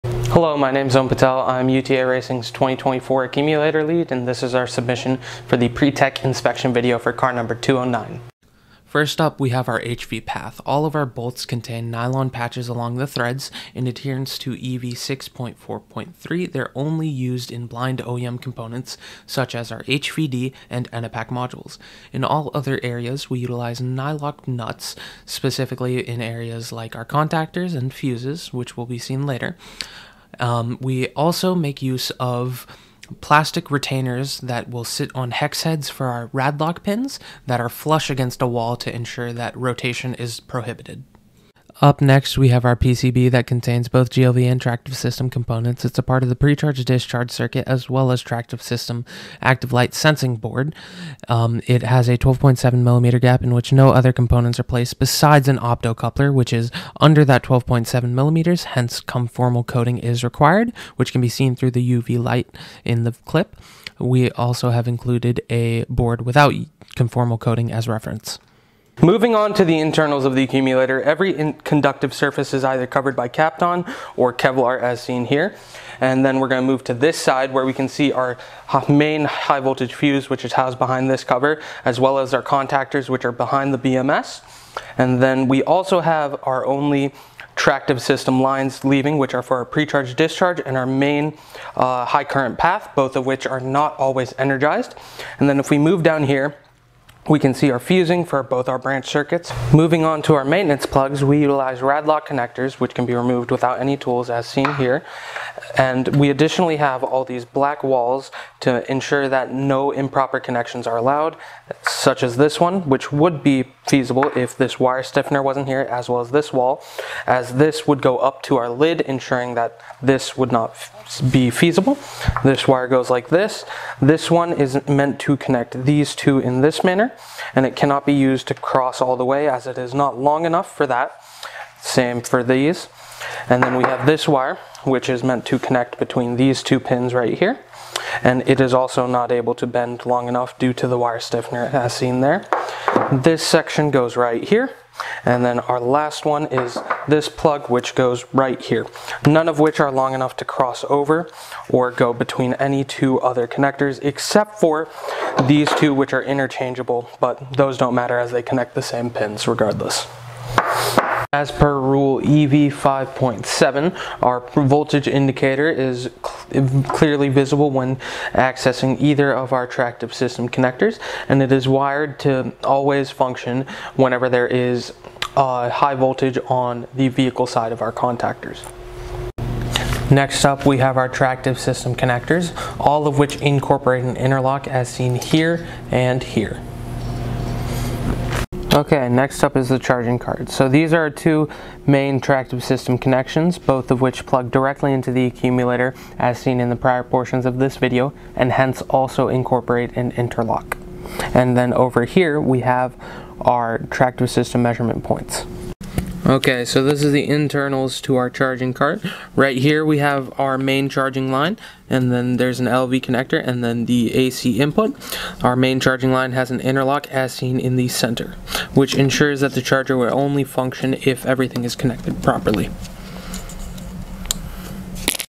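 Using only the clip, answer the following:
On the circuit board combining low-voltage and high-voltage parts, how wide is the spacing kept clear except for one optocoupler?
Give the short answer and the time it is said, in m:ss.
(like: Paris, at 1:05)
12.7 millimeters, at 0:52.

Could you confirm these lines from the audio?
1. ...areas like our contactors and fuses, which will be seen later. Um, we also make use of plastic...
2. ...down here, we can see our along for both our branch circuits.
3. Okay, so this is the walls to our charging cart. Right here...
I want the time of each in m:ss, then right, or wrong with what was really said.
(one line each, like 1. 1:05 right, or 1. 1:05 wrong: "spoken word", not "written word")
1. 0:26 right
2. 1:36 wrong: "fusing", not "along"
3. 3:26 wrong: "internals", not "walls".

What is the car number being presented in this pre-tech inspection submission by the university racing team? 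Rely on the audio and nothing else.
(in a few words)
209.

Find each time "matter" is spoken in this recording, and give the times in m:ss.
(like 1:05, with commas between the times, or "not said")
2:37.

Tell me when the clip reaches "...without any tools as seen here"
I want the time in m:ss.
1:43.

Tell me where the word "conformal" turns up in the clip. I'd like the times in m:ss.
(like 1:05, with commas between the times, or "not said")
0:59, 1:06.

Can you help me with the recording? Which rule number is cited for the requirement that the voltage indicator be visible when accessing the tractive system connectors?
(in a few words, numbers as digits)
EV 5.7.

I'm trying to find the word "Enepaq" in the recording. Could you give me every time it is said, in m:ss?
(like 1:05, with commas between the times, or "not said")
0:20.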